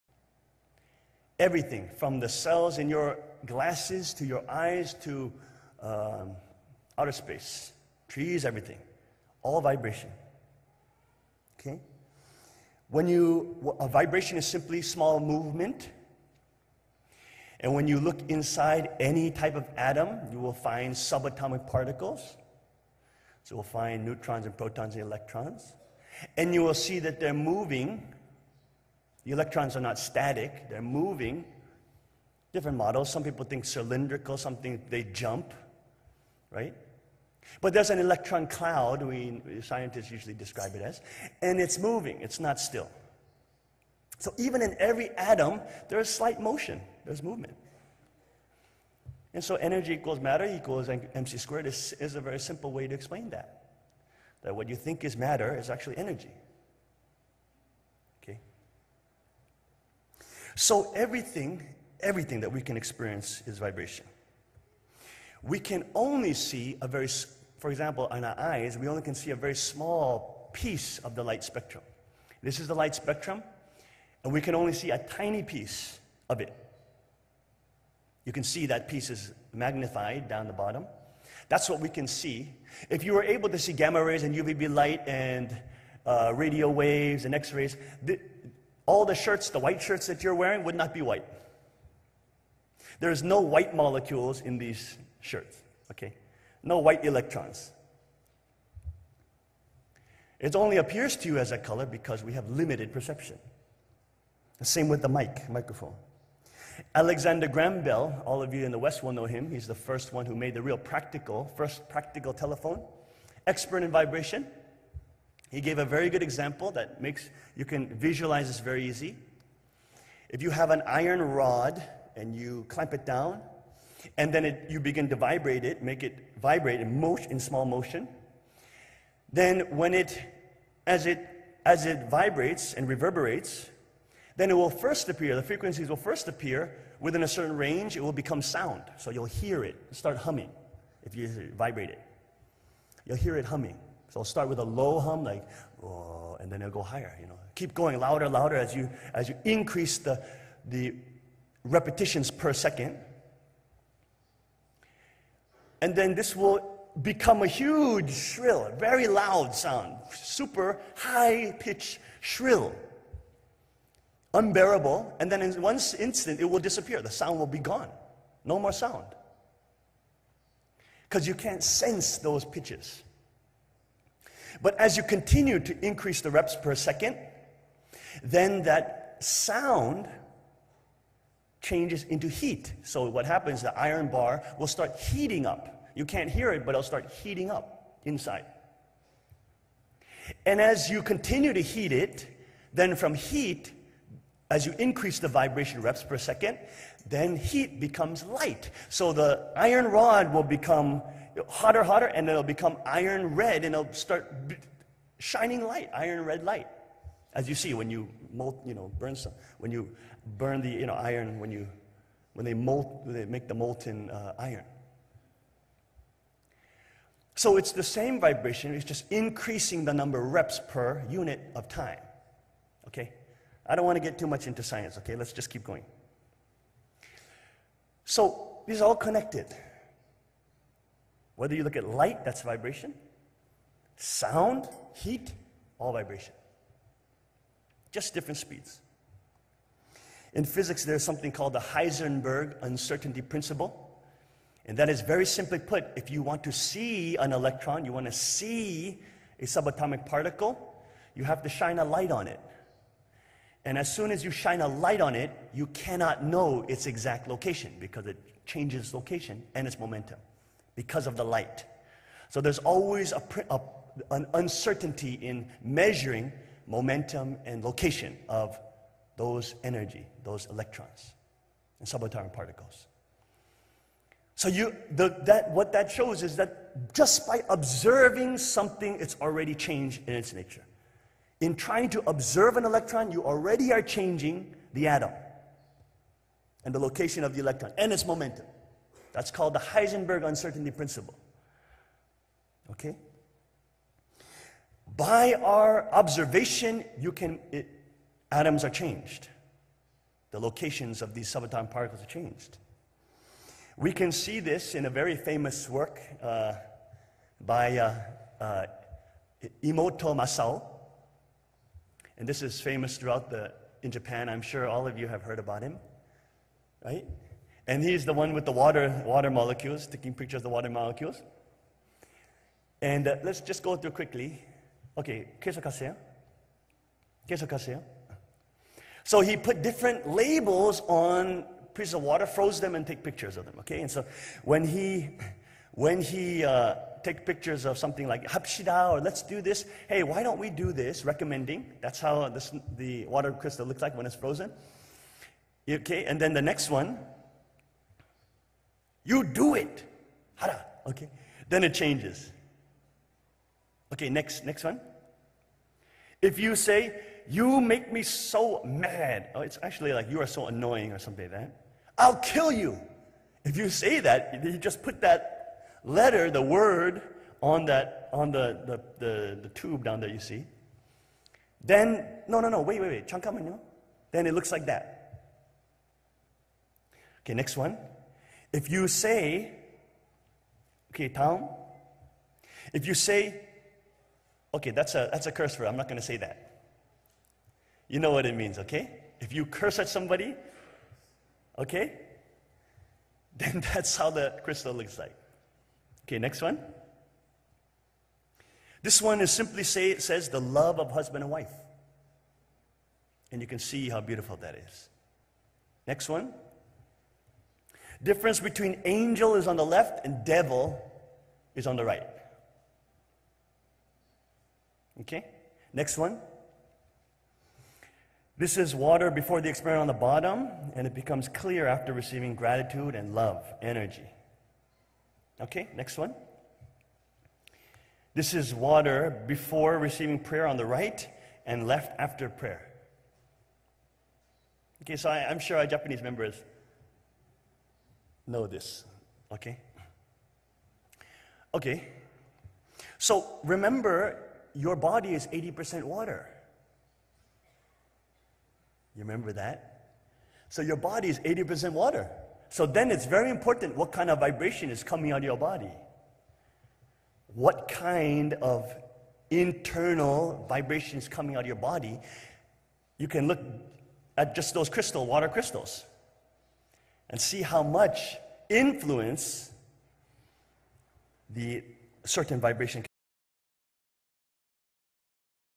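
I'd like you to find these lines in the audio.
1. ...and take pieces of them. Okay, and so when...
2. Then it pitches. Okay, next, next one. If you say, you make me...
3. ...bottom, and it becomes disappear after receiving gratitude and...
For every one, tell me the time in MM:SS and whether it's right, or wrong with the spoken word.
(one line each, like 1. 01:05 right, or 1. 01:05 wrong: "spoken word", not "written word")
1. 05:32 wrong: "pictures", not "pieces"
2. 05:51 wrong: "changes", not "pitches"
3. 06:59 wrong: "clear", not "disappear".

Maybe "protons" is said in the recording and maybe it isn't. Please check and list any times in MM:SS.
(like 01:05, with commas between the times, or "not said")
00:24.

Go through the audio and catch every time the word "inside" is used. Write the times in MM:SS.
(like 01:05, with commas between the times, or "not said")
00:18, 03:08.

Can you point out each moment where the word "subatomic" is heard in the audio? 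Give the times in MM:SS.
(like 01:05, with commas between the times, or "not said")
00:20, 04:09, 04:31, 05:01.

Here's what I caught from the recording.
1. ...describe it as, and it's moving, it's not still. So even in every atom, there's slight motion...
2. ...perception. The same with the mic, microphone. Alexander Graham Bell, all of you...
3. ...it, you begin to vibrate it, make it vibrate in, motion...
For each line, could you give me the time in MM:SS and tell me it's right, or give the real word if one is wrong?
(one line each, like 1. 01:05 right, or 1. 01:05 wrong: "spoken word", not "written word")
1. 00:40 right
2. 01:42 right
3. 02:04 right.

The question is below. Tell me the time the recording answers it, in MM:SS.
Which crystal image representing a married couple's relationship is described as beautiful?
06:40.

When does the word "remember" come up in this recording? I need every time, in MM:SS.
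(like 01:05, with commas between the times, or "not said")
07:23, 07:29.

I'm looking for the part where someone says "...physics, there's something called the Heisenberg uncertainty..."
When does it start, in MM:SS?
04:00.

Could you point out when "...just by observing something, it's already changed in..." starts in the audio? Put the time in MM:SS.
04:36.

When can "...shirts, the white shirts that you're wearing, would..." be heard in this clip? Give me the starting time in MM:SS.
01:29.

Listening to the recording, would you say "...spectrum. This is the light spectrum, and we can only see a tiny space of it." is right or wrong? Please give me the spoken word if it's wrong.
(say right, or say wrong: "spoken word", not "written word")
wrong: "piece", not "space".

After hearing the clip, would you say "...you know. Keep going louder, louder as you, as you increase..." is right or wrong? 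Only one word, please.
right.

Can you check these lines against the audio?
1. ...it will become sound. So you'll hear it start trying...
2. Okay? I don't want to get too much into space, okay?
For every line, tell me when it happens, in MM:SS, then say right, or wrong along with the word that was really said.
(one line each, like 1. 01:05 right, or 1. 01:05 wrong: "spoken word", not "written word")
1. 02:17 wrong: "humming", not "trying"
2. 03:42 wrong: "science", not "space".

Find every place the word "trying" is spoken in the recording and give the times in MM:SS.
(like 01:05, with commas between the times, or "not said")
04:41.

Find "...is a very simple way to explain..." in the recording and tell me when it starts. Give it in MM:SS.
00:52.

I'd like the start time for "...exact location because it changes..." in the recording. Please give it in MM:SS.
04:16.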